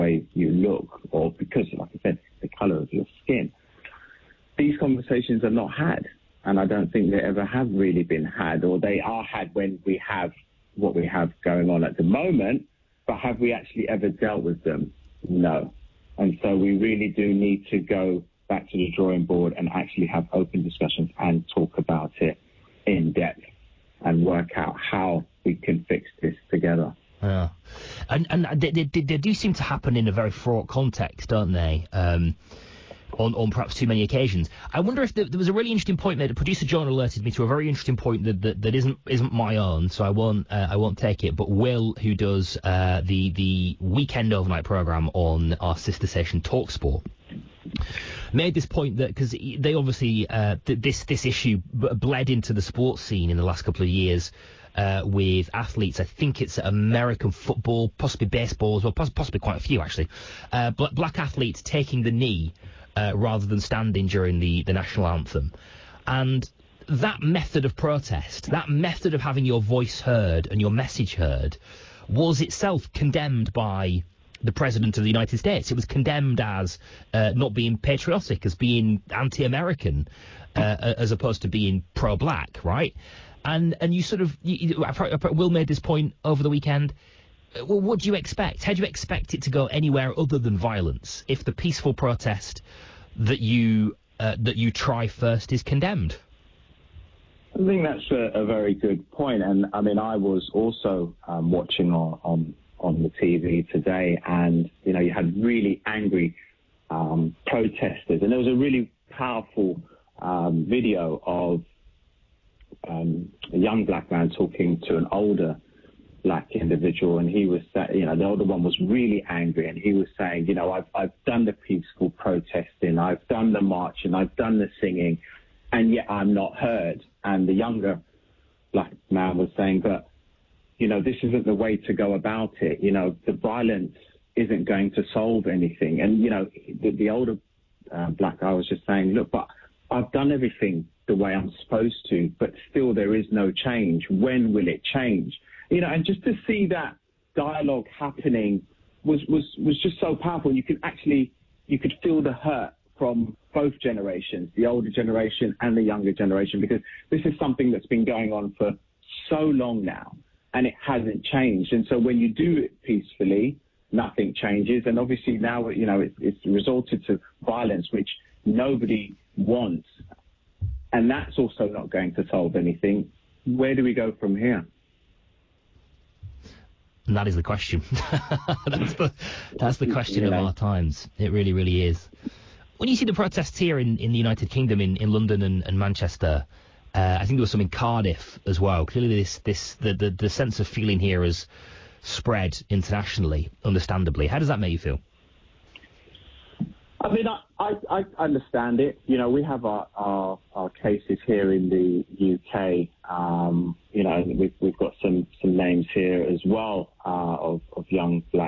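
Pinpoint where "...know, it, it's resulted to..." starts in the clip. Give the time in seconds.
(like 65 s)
165 s.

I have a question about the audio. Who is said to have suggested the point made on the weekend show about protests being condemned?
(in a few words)
Producer John.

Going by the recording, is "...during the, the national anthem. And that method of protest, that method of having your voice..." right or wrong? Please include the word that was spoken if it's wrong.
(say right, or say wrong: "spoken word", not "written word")
right.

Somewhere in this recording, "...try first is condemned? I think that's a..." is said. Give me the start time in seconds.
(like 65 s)
94 s.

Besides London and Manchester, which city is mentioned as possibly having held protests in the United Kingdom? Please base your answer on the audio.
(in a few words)
Cardiff.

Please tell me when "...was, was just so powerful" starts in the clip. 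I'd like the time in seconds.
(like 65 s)
149 s.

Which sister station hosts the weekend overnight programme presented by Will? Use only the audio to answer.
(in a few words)
Talksport.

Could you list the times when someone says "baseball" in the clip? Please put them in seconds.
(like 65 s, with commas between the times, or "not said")
58 s.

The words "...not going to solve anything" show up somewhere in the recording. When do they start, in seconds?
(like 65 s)
171 s.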